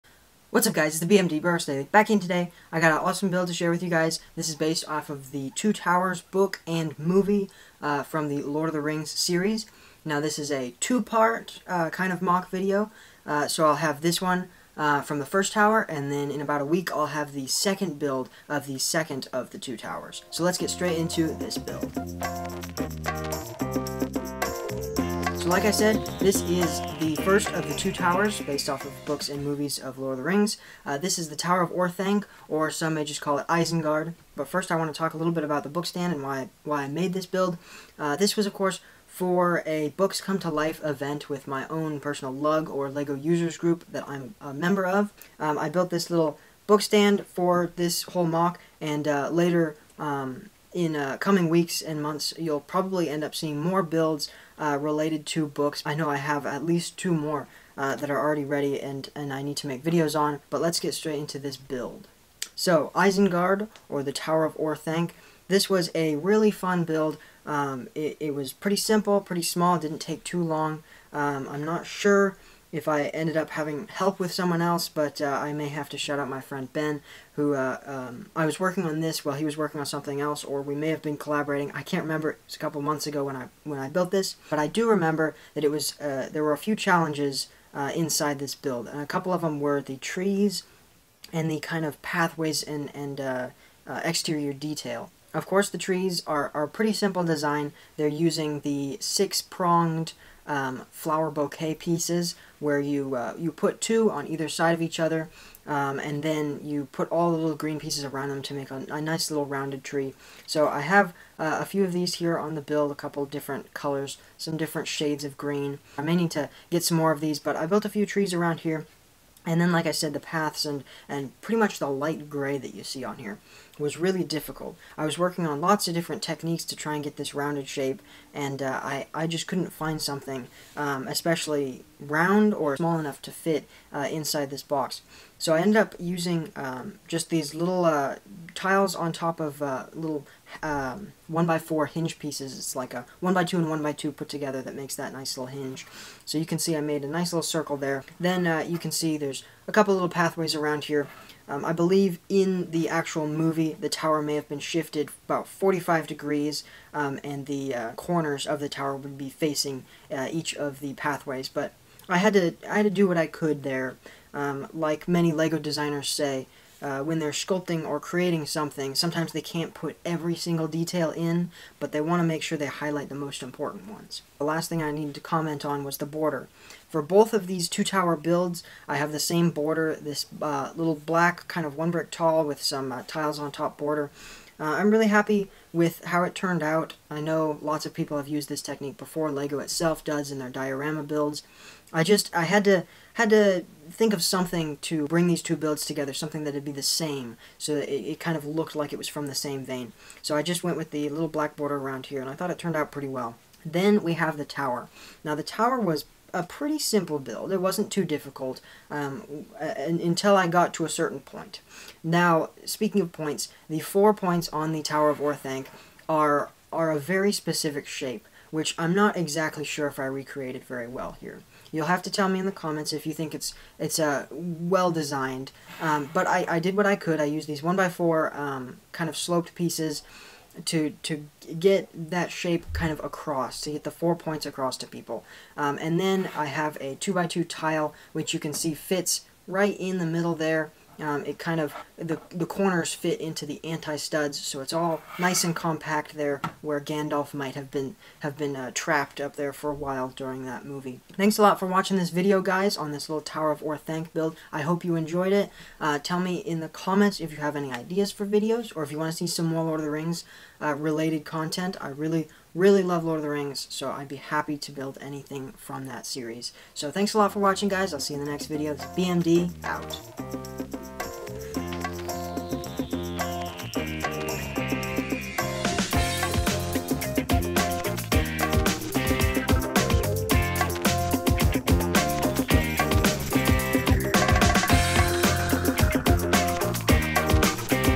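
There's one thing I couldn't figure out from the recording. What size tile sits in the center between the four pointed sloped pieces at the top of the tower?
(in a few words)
2 by 2.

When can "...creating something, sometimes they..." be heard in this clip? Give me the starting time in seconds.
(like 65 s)
167 s.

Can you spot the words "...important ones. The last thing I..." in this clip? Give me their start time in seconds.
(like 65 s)
173 s.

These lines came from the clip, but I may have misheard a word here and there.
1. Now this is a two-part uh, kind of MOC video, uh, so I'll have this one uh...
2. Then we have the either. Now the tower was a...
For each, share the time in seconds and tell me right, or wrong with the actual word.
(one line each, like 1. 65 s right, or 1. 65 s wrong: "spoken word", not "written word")
1. 10 s right
2. 203 s wrong: "tower", not "either".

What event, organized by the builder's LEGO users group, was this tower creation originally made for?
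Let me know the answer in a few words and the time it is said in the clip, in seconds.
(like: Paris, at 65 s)
Books Come to Life, at 39 s.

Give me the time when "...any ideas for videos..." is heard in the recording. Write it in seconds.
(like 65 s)
257 s.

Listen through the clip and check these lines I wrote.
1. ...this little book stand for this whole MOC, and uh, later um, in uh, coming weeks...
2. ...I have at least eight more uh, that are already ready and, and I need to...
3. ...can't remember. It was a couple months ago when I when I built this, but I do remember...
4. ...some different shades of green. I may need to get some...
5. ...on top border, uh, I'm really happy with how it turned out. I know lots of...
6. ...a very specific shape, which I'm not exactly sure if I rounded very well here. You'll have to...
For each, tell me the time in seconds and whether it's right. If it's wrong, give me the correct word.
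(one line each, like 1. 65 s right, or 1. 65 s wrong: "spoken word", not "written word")
1. 45 s right
2. 56 s wrong: "two", not "eight"
3. 81 s right
4. 114 s right
5. 183 s right
6. 216 s wrong: "recreated", not "rounded".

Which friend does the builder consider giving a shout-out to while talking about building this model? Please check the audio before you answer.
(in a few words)
Ben.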